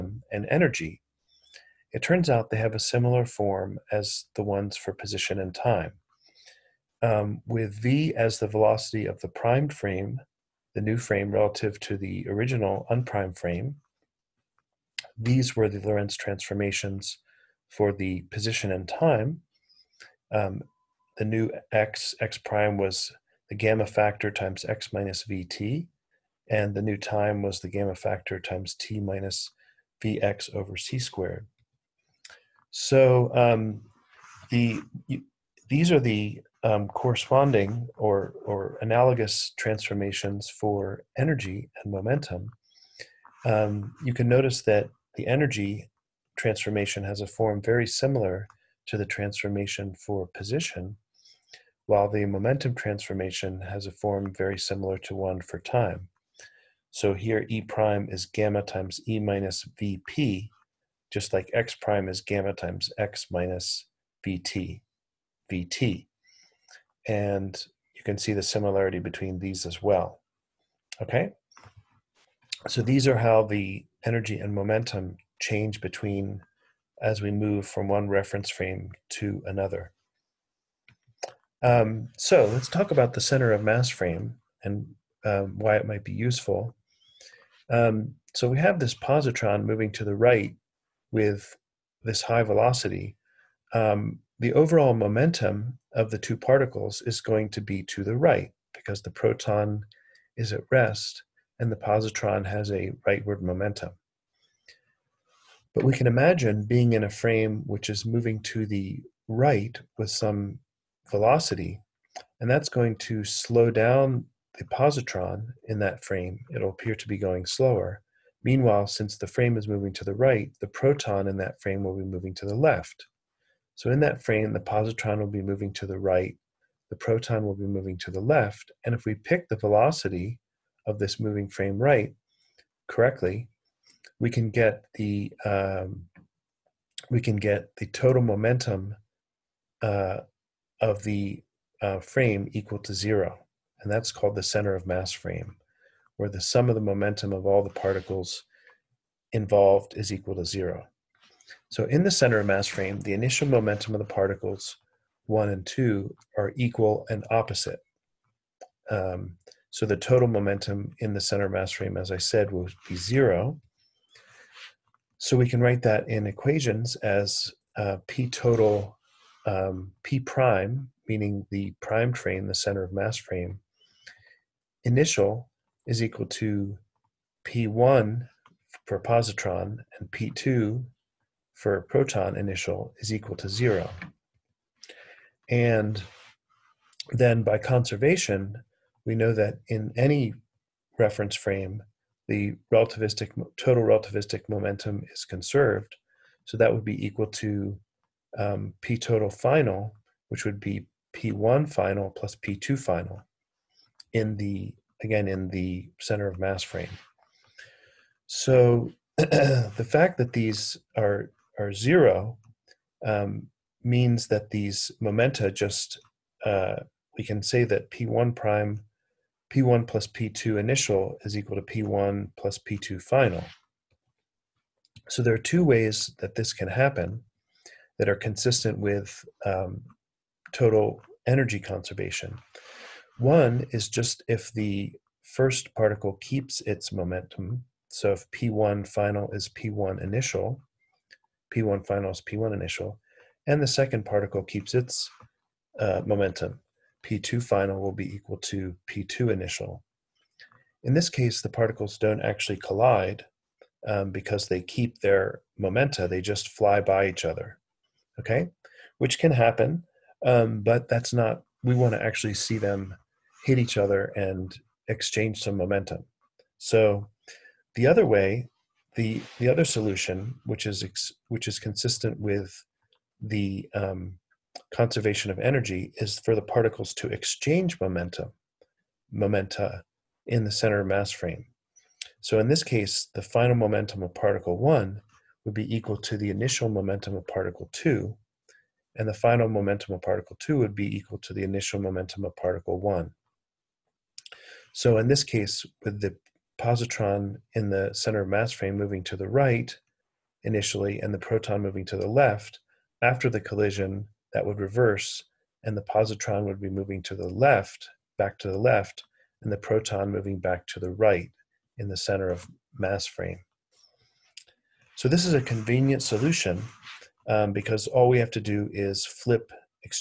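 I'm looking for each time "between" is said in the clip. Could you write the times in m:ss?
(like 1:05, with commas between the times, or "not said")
1:08, 1:15.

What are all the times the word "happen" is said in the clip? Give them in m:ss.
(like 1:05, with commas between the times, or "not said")
3:46, 4:19.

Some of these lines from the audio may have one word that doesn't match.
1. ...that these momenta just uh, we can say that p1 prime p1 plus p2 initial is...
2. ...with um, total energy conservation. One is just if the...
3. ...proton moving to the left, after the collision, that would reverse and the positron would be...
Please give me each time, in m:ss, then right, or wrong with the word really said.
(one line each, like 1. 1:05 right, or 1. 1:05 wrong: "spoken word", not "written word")
1. 3:34 right
2. 3:48 right
3. 5:01 right.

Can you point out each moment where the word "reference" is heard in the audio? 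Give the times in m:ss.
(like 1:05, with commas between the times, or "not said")
1:18, 3:10.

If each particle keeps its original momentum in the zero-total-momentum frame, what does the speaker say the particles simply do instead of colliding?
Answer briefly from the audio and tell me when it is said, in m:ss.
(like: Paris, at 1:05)
fly by each other, at 4:16.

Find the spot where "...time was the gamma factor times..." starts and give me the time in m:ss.
0:26.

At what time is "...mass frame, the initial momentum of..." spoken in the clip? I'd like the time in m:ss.
2:32.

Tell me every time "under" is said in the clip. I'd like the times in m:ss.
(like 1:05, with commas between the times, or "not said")
not said.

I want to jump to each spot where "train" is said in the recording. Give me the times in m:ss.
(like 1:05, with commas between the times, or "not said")
2:52.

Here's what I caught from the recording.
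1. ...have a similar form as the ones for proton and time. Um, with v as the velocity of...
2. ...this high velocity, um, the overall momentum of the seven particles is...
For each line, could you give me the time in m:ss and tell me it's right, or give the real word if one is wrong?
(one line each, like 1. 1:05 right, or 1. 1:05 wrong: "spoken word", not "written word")
1. 0:02 wrong: "position", not "proton"
2. 1:32 wrong: "two", not "seven".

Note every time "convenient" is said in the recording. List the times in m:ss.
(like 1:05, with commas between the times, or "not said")
5:15.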